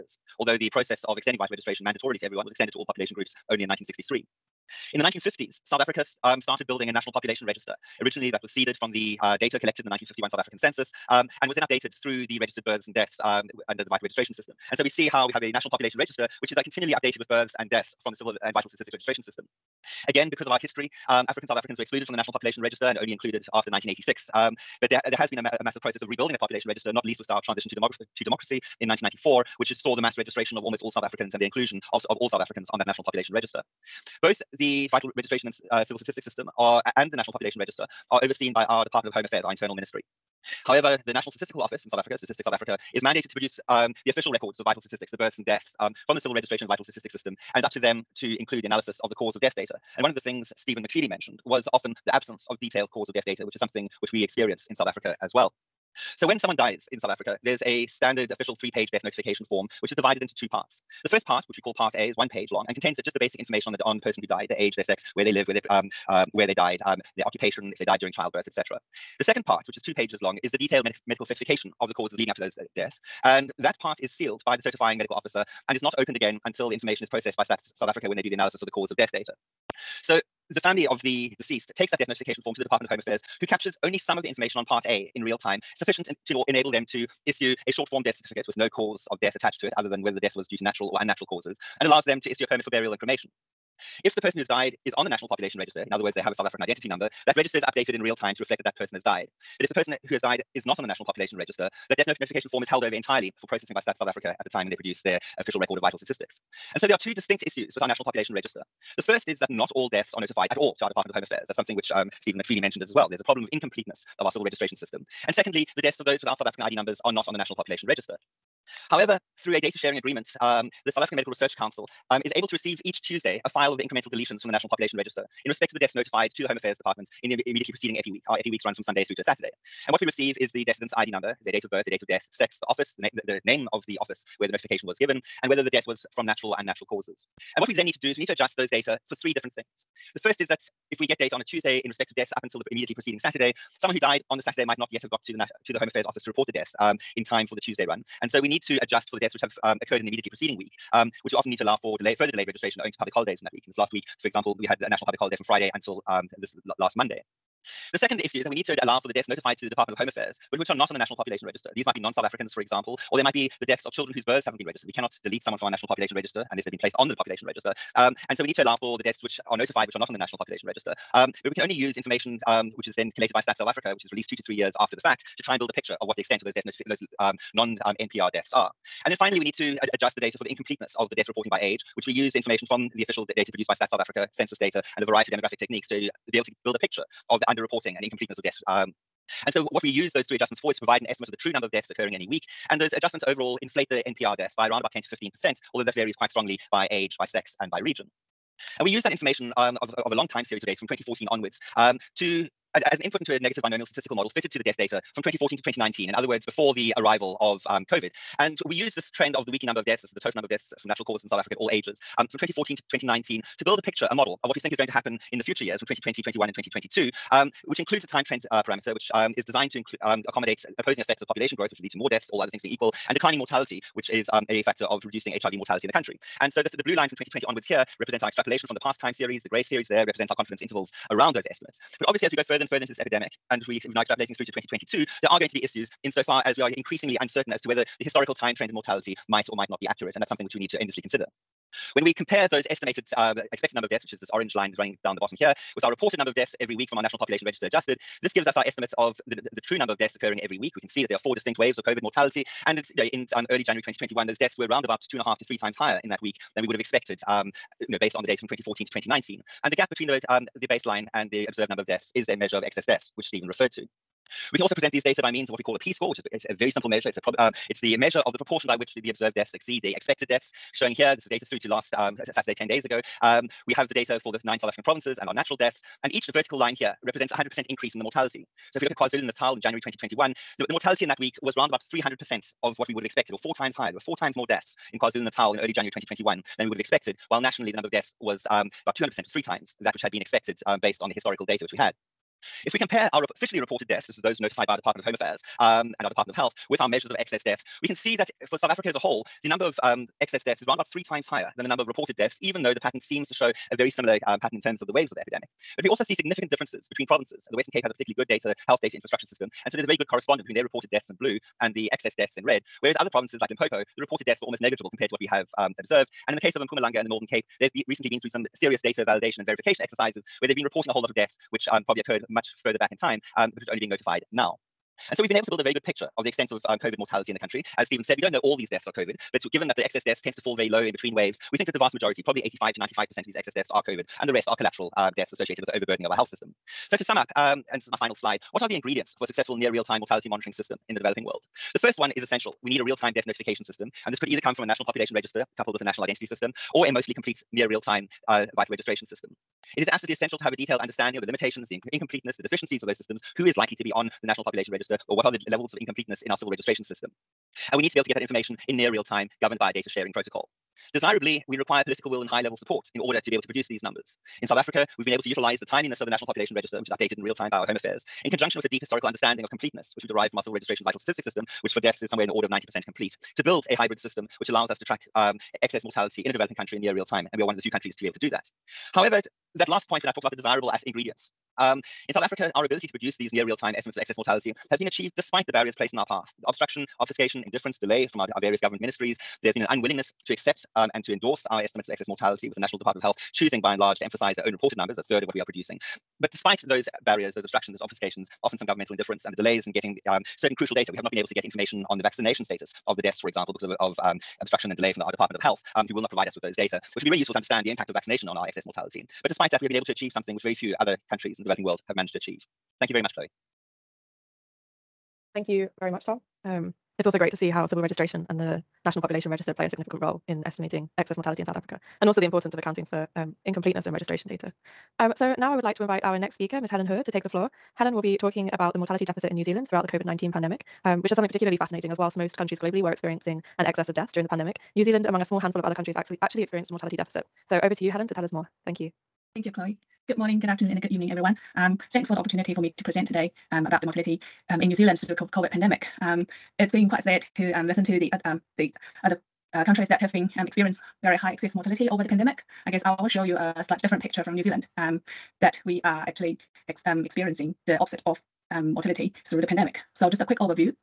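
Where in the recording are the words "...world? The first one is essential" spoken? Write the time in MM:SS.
05:41.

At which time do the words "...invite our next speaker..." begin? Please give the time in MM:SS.
07:05.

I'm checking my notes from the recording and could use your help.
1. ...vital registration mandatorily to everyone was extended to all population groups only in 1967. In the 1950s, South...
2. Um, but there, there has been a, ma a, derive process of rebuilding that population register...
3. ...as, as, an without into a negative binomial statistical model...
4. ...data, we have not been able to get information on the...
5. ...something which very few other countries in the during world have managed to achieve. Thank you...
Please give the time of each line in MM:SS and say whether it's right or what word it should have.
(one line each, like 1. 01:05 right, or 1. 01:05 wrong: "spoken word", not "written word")
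1. 00:01 wrong: "1963", not "1967"
2. 00:24 wrong: "massive", not "derive"
3. 03:22 wrong: "input", not "without"
4. 06:40 right
5. 06:50 wrong: "developing", not "during".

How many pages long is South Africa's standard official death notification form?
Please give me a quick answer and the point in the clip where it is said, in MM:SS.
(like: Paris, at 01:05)
3, at 00:58.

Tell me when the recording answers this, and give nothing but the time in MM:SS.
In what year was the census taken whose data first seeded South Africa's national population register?
00:09.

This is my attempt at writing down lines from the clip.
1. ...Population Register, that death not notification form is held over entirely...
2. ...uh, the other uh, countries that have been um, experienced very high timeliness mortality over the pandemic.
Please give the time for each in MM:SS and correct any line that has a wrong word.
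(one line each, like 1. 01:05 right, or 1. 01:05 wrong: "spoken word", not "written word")
1. 01:41 right
2. 07:28 wrong: "excess", not "timeliness".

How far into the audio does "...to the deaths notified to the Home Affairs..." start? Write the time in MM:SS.
02:05.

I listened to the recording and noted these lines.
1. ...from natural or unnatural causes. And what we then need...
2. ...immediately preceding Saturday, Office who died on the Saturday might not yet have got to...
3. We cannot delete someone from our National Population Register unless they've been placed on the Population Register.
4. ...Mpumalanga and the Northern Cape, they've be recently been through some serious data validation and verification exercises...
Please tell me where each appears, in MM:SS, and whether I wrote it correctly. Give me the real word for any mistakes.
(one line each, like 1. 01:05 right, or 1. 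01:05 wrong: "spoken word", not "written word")
1. 02:16 right
2. 02:22 wrong: "Someone", not "Office"
3. 02:44 right
4. 05:16 right.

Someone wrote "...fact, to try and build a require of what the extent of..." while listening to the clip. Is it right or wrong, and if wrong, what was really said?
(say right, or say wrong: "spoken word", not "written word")
wrong: "picture", not "require".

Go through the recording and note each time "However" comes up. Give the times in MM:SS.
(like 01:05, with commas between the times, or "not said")
00:40, 01:58, 06:18.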